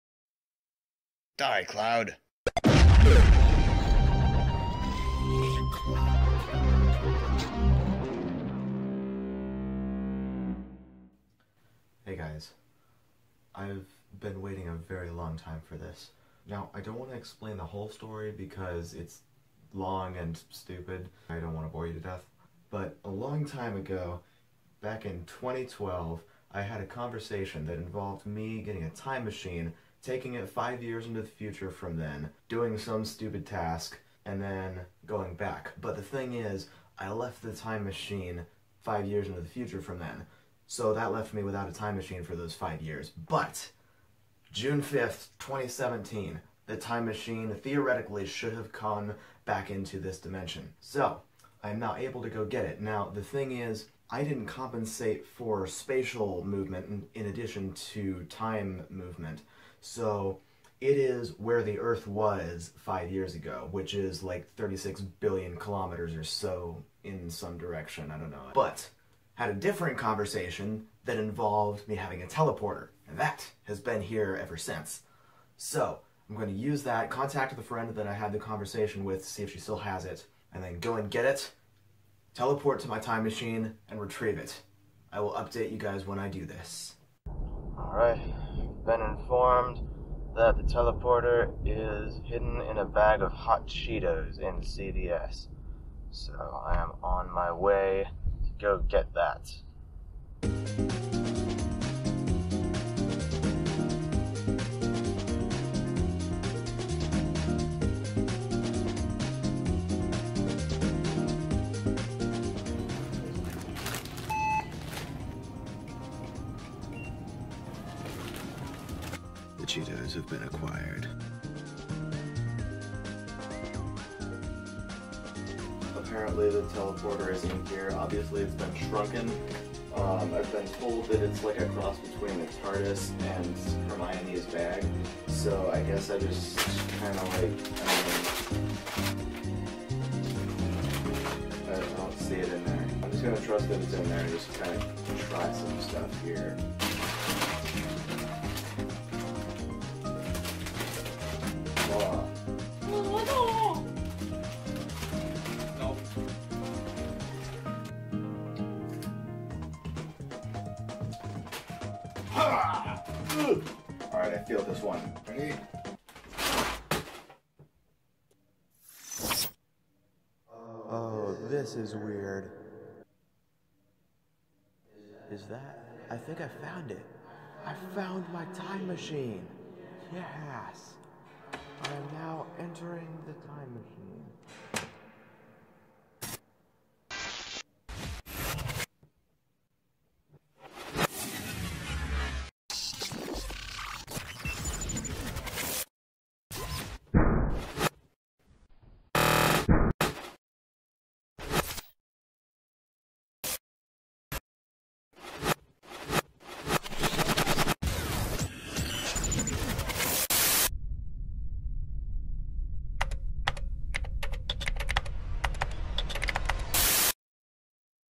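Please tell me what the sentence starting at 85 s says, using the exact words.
I will update you guys when I do this.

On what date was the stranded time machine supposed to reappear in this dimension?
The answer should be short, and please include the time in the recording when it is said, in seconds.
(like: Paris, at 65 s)
June 5th, 2017, at 44 s.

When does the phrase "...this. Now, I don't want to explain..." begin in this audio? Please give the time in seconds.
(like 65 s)
15 s.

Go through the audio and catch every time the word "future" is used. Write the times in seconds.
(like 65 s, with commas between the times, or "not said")
31 s, 39 s.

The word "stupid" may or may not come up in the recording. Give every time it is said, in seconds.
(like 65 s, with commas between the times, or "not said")
20 s, 33 s.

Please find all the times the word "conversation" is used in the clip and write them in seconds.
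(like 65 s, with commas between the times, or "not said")
26 s, 69 s, 78 s.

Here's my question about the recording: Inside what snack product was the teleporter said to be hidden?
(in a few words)
Hot Cheetos.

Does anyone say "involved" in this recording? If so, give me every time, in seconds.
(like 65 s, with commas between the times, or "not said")
27 s, 71 s.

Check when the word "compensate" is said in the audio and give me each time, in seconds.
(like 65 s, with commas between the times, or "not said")
54 s.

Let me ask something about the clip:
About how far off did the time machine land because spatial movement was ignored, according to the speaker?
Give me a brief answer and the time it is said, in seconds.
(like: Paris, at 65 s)
36 billion kilometers, at 64 s.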